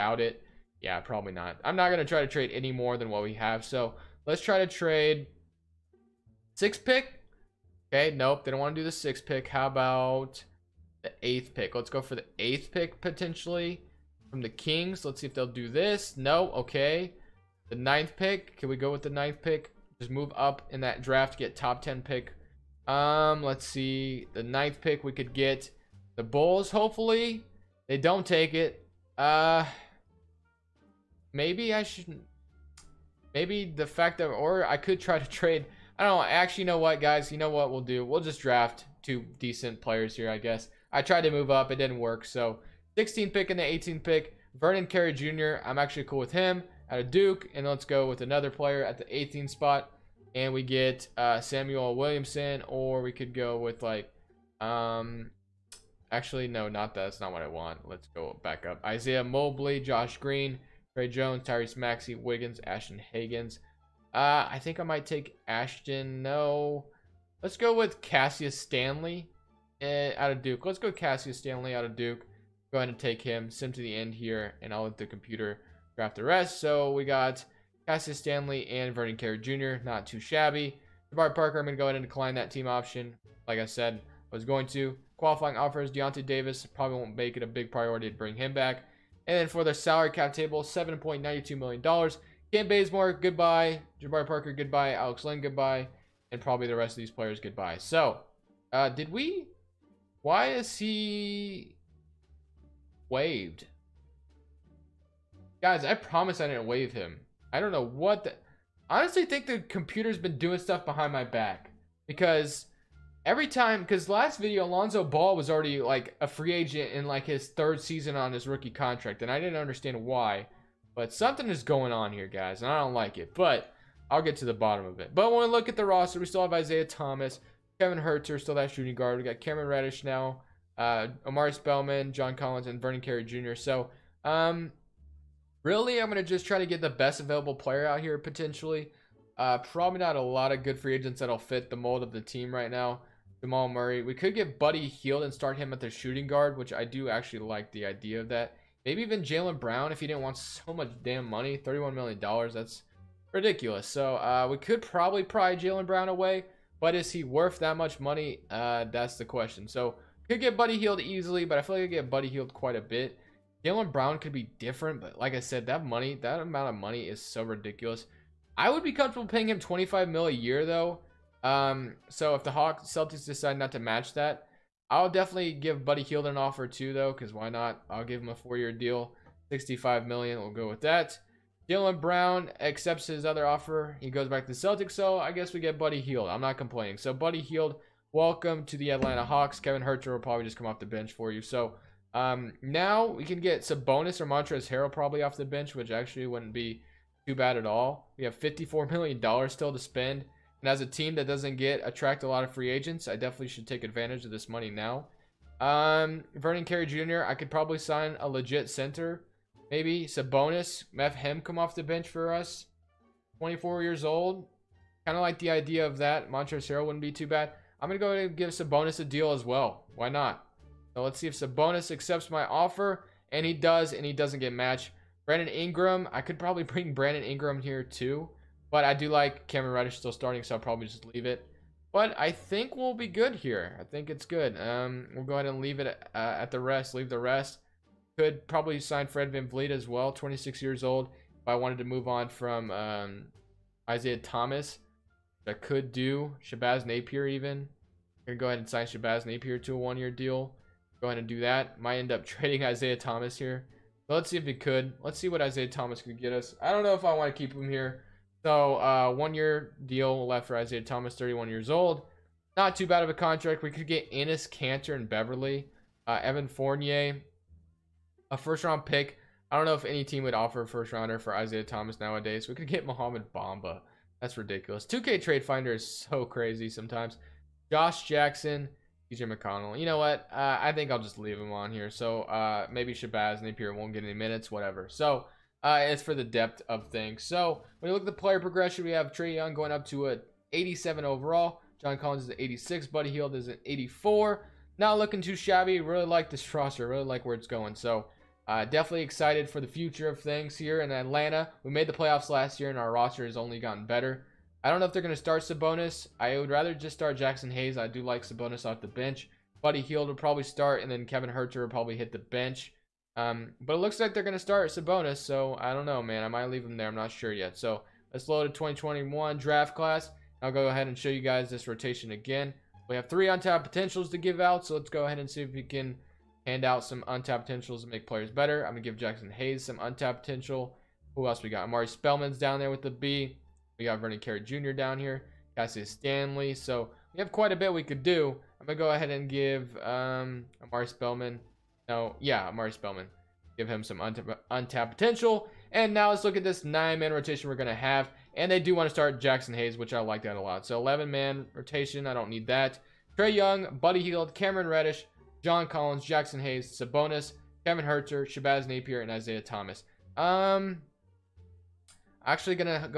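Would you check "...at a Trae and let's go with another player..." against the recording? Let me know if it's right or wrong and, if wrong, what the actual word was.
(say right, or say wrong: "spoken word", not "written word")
wrong: "Duke", not "Trae".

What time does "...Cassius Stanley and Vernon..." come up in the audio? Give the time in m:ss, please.
1:17.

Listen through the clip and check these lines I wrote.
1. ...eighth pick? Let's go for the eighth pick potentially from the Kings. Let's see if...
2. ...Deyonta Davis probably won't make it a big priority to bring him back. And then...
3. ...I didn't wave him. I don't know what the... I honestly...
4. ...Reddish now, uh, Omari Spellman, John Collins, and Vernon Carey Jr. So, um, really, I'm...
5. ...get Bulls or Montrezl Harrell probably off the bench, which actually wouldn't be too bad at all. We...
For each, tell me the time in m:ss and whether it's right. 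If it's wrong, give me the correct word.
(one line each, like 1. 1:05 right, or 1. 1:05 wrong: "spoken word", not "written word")
1. 0:11 right
2. 1:25 right
3. 1:46 right
4. 2:09 right
5. 3:13 wrong: "Sabonis", not "Bulls".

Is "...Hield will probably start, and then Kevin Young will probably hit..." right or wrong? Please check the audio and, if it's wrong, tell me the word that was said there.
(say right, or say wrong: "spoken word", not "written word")
wrong: "Huerter", not "Young".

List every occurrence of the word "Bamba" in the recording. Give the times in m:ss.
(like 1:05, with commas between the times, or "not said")
4:33.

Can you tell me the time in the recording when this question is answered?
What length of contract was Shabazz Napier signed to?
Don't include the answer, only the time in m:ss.
4:09.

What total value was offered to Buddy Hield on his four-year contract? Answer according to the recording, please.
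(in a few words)
65 million.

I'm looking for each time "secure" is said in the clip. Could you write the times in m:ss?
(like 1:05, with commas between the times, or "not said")
not said.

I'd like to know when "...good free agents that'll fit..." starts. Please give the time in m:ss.
2:20.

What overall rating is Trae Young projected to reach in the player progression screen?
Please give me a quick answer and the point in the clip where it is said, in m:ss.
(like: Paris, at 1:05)
87, at 4:50.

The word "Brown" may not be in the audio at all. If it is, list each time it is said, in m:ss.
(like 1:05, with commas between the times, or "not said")
2:29, 2:35, 2:43, 3:02.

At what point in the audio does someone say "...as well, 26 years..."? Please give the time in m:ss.
3:59.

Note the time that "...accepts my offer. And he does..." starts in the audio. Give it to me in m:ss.
3:41.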